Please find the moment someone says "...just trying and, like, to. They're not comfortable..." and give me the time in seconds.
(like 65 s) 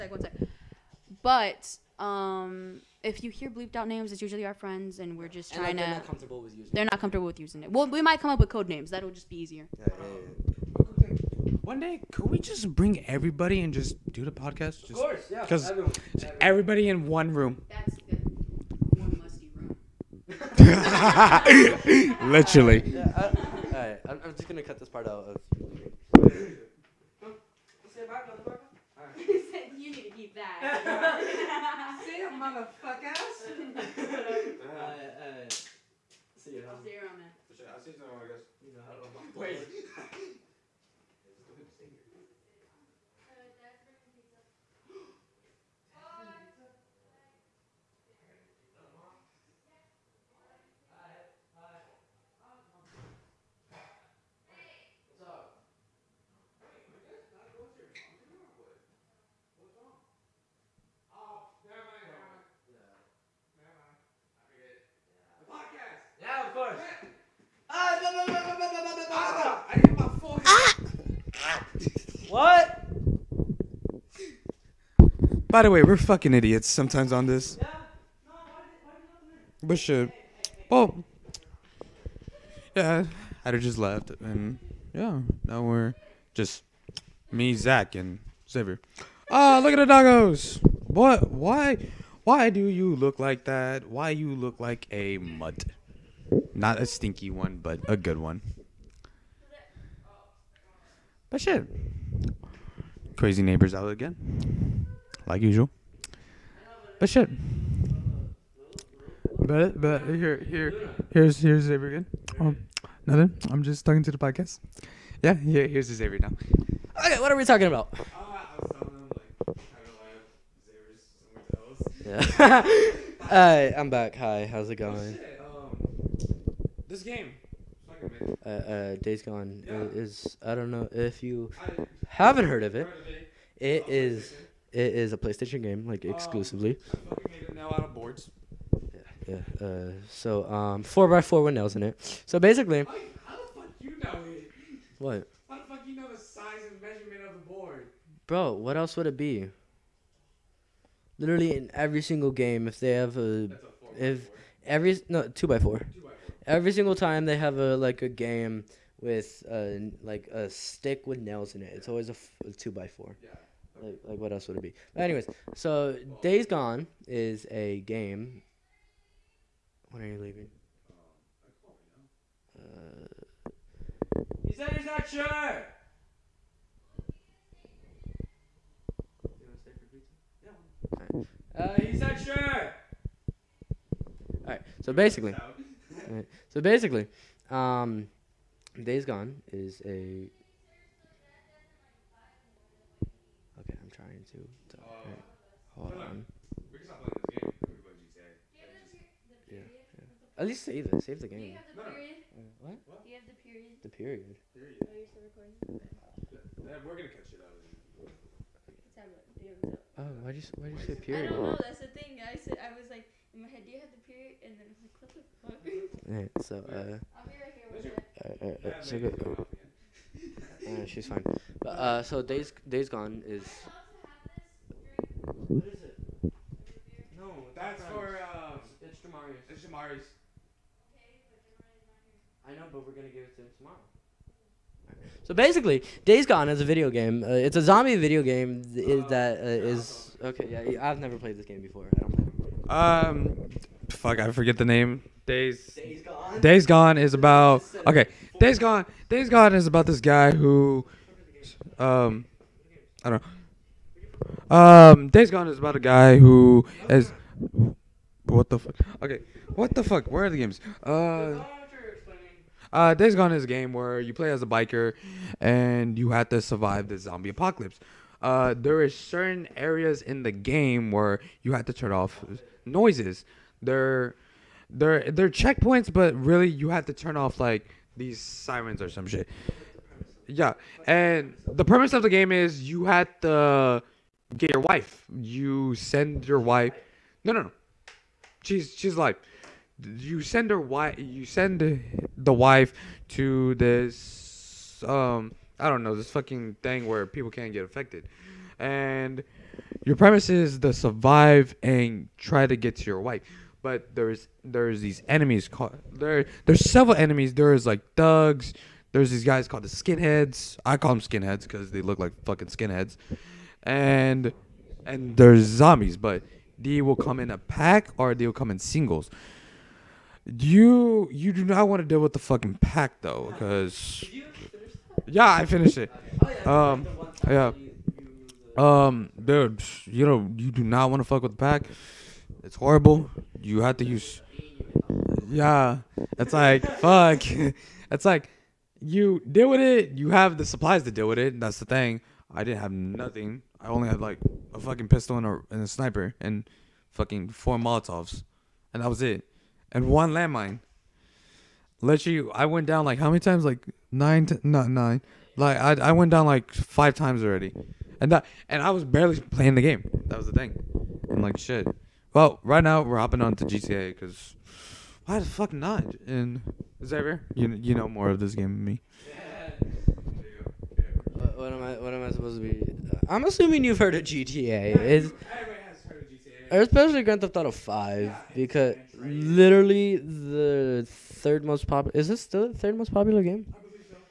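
5 s.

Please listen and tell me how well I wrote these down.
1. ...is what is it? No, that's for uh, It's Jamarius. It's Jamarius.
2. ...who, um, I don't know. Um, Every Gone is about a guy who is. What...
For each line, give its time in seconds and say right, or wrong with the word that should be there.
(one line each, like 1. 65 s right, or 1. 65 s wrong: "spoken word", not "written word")
1. 223 s right
2. 250 s wrong: "Days", not "Every".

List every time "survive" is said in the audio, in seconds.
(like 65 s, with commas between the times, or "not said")
266 s, 300 s.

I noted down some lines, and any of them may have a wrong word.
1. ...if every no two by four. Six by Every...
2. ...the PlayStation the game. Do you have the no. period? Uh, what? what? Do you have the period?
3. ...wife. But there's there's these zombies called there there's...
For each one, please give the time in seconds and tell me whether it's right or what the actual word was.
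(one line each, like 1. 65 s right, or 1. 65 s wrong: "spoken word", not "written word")
1. 154 s wrong: "Two", not "Six"
2. 200 s wrong: "Save", not "PlayStation"
3. 302 s wrong: "enemies", not "zombies".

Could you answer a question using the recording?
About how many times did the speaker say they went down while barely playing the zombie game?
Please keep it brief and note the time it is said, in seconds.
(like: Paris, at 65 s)
5, at 356 s.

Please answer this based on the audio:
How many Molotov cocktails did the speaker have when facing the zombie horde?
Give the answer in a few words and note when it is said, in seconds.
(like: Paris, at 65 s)
4, at 347 s.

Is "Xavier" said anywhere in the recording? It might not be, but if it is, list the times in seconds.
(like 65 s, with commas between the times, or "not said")
88 s, 111 s, 115 s, 366 s.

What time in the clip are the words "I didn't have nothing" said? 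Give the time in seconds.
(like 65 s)
342 s.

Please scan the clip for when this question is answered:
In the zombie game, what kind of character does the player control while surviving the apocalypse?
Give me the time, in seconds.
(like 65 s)
264 s.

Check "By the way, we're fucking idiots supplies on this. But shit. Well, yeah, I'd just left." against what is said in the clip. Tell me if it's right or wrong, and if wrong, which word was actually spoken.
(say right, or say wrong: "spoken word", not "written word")
wrong: "sometimes", not "supplies".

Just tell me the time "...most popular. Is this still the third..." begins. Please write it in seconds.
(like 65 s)
381 s.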